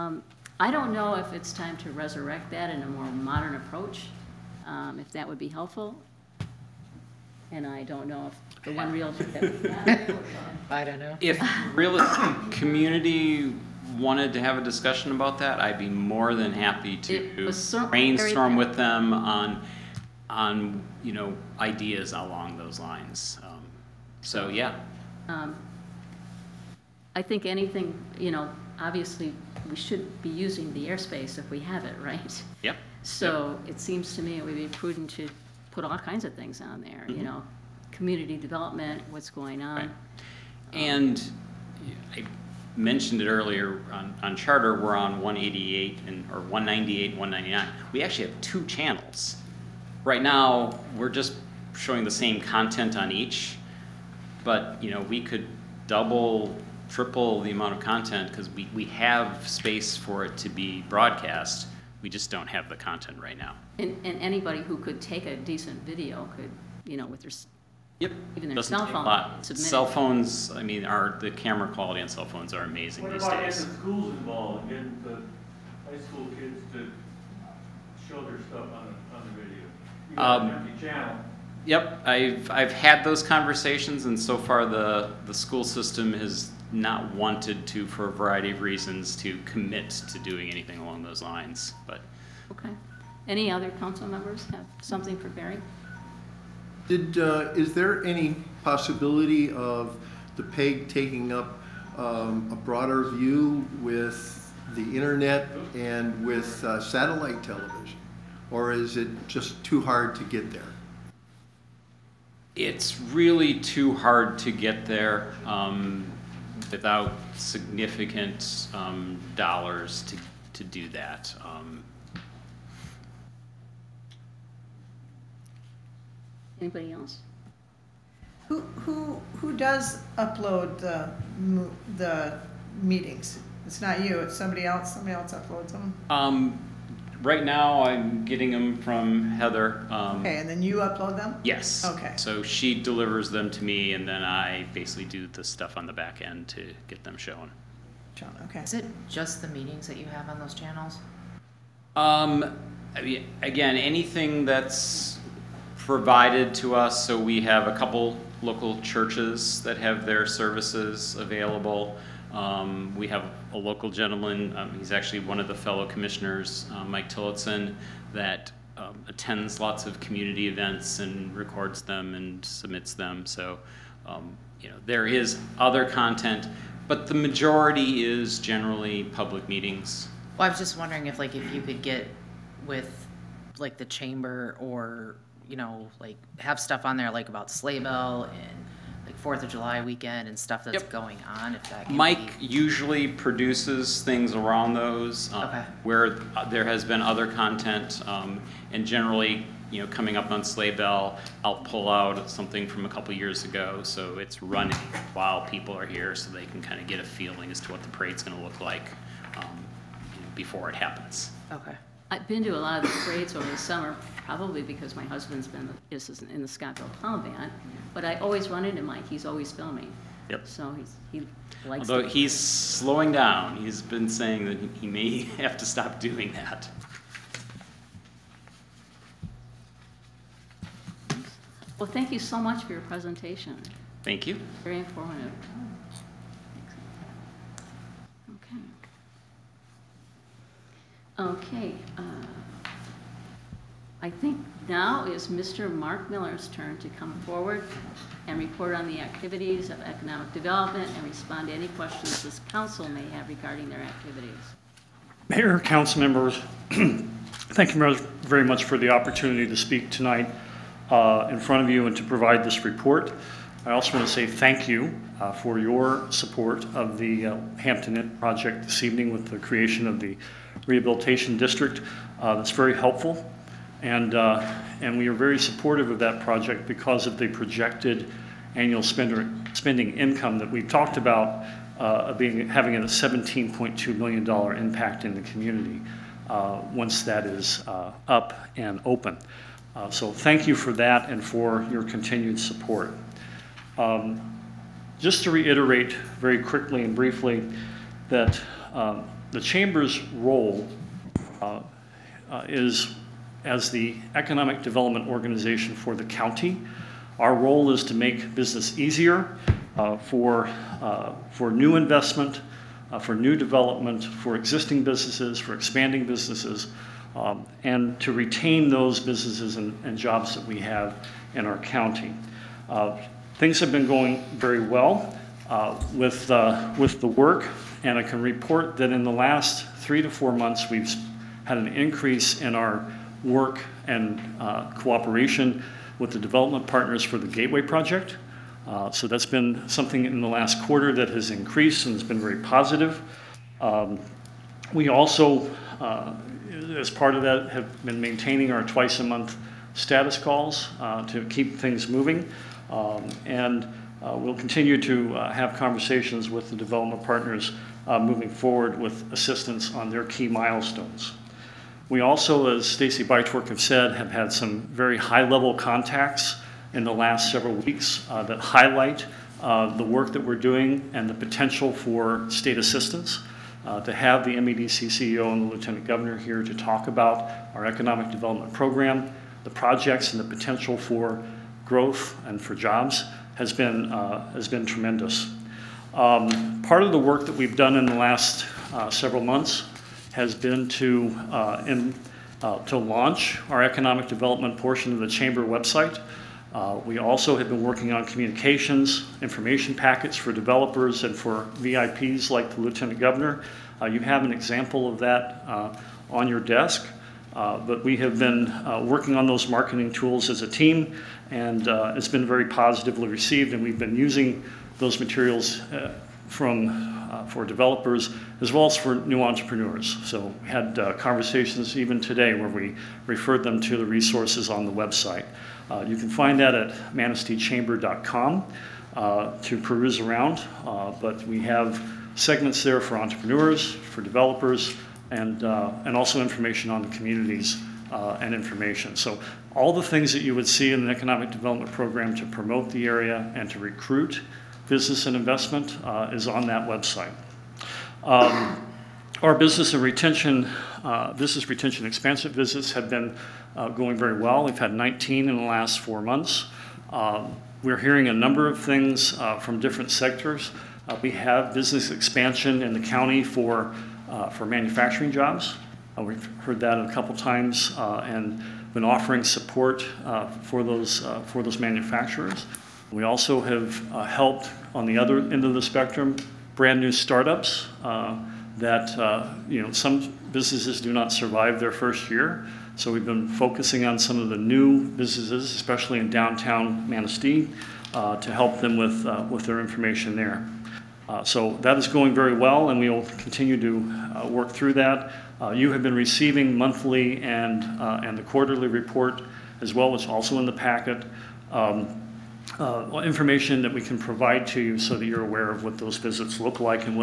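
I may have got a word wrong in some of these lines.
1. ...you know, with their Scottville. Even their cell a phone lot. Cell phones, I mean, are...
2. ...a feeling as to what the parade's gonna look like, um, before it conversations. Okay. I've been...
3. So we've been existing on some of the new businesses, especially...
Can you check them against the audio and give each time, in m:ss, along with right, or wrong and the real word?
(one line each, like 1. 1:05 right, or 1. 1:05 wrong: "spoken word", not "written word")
1. 1:06 wrong: "Yep", not "Scottville"
2. 3:26 wrong: "happens", not "conversations"
3. 8:02 wrong: "focusing", not "existing".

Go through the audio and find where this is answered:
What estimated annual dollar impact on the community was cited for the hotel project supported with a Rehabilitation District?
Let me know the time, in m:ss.
4:42.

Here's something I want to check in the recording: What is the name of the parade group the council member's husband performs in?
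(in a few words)
Scottville Clown Band.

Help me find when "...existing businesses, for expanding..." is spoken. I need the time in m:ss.
5:14.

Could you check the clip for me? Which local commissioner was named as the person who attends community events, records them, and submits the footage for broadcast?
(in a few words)
Mike Tillotson.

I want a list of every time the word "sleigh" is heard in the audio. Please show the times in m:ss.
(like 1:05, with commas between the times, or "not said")
3:07, 3:20.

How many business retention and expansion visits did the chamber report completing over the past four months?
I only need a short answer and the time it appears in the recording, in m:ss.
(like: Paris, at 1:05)
19, at 7:34.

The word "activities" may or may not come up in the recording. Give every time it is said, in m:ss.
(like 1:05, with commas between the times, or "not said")
4:09, 4:13.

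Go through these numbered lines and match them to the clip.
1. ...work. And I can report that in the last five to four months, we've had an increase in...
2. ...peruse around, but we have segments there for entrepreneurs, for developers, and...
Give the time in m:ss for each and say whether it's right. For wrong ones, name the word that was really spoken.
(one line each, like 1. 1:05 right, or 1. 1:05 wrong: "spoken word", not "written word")
1. 5:27 wrong: "three", not "five"
2. 7:09 right.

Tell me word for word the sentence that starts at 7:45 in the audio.
we've heard that a couple times and been offering support for, those, for those manufacturers.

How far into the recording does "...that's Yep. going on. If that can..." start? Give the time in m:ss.
3:10.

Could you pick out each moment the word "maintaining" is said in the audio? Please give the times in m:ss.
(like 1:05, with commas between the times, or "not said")
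5:47.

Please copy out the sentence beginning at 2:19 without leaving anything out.
Um, Okay, and then you upload them?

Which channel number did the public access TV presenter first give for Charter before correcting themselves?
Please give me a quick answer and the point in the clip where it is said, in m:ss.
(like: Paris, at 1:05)
188, at 0:45.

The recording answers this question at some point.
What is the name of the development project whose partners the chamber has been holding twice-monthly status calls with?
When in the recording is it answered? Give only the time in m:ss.
5:37.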